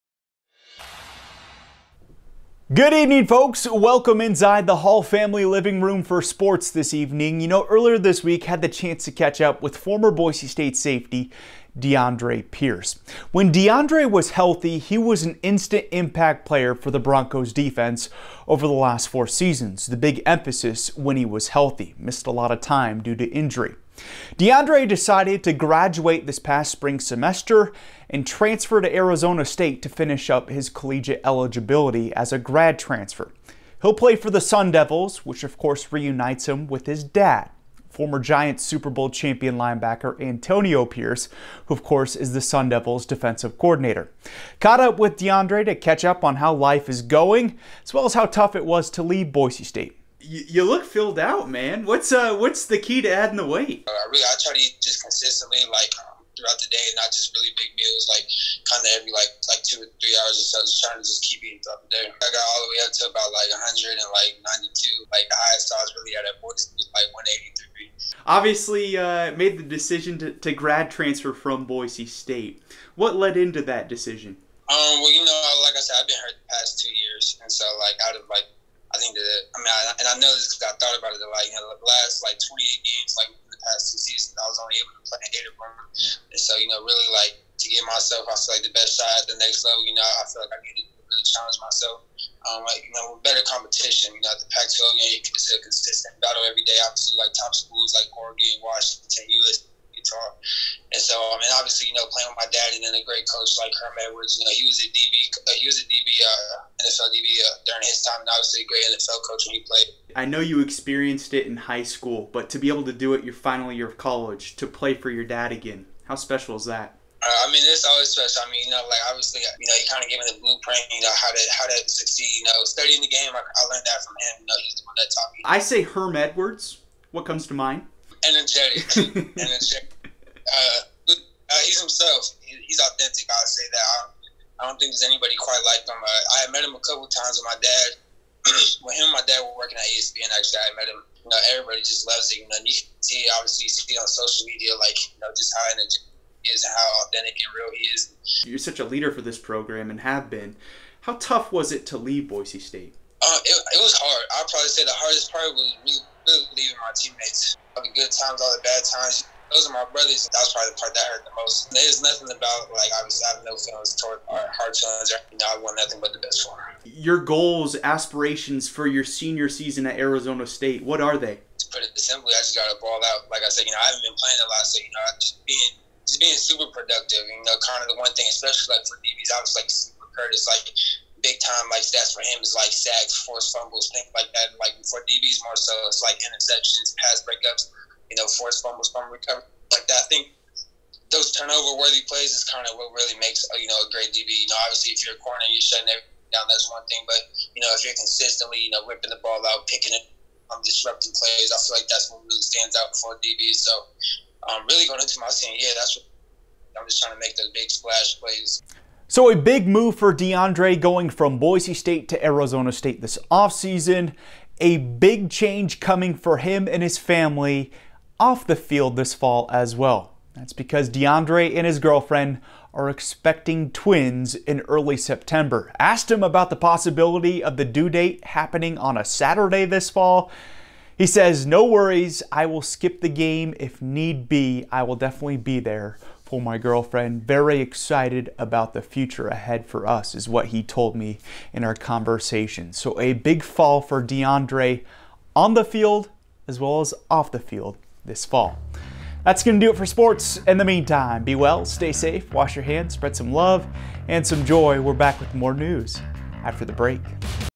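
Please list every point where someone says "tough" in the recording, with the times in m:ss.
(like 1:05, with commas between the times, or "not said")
0:48, 2:31.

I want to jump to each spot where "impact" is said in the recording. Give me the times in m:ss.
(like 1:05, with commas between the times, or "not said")
0:15.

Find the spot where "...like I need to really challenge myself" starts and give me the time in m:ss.
1:30.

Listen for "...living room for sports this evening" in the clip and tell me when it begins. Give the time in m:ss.
0:05.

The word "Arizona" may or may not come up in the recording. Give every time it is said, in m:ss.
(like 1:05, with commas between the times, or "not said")
0:28, 2:49, 3:32.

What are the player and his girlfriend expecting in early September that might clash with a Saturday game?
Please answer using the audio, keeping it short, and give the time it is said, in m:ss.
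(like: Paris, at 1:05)
Twins, at 3:43.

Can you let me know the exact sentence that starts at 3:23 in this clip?
So, um, really going into my team, yeah, that's what I'm just trying to make those big splash plays.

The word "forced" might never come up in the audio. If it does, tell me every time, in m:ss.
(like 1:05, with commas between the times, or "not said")
3:03, 3:08.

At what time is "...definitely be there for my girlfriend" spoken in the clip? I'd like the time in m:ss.
3:54.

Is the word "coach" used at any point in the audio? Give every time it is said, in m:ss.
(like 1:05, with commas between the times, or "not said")
1:43, 1:49.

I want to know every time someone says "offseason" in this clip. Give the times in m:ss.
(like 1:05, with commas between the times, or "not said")
3:33.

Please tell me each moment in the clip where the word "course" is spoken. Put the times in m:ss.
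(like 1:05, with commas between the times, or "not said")
0:35, 0:41.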